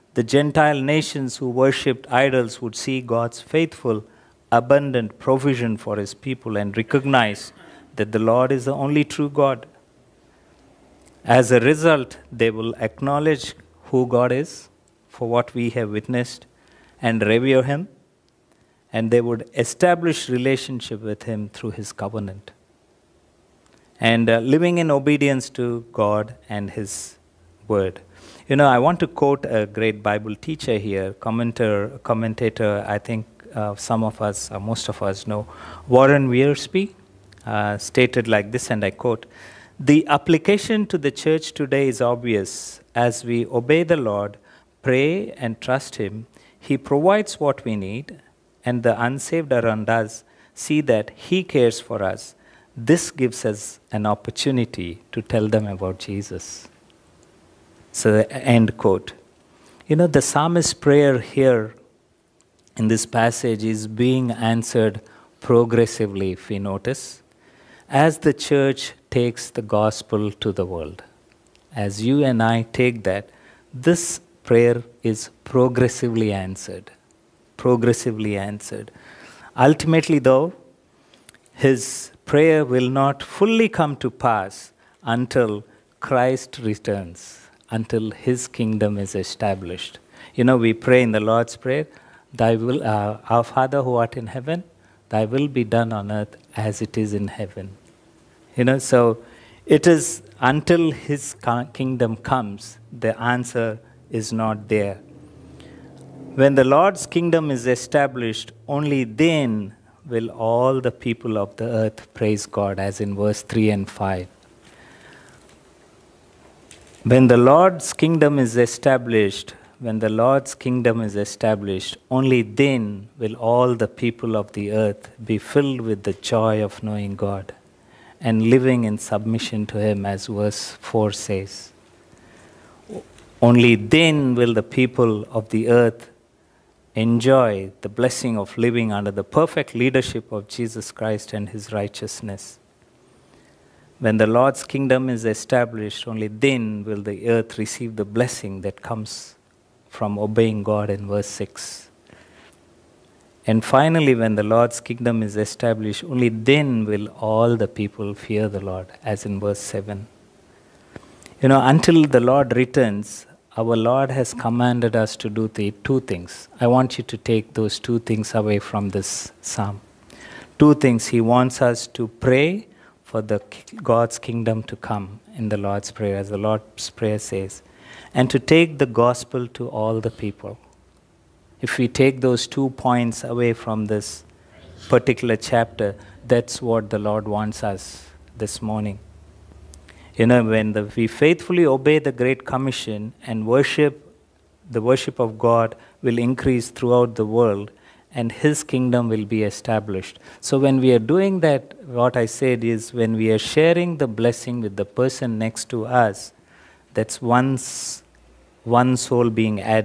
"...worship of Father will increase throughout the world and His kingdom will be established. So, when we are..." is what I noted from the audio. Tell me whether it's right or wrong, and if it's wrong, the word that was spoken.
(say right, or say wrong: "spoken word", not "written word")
wrong: "God", not "Father".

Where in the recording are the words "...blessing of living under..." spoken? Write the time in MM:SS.
02:17.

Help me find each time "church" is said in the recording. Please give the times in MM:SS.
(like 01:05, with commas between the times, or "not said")
00:41, 01:08.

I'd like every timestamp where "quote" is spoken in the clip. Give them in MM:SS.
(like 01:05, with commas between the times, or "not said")
00:29, 00:38, 00:58.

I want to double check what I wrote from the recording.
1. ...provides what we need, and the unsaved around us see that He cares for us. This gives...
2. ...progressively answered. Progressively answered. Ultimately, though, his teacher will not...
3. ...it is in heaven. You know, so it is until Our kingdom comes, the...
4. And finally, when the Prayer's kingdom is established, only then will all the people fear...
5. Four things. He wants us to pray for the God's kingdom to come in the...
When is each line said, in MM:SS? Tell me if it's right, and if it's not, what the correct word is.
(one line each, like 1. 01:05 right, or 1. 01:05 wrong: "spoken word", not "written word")
1. 00:46 right
2. 01:15 wrong: "prayer", not "teacher"
3. 01:36 wrong: "His", not "Our"
4. 02:33 wrong: "Lord", not "Prayer"
5. 02:50 wrong: "Two", not "Four".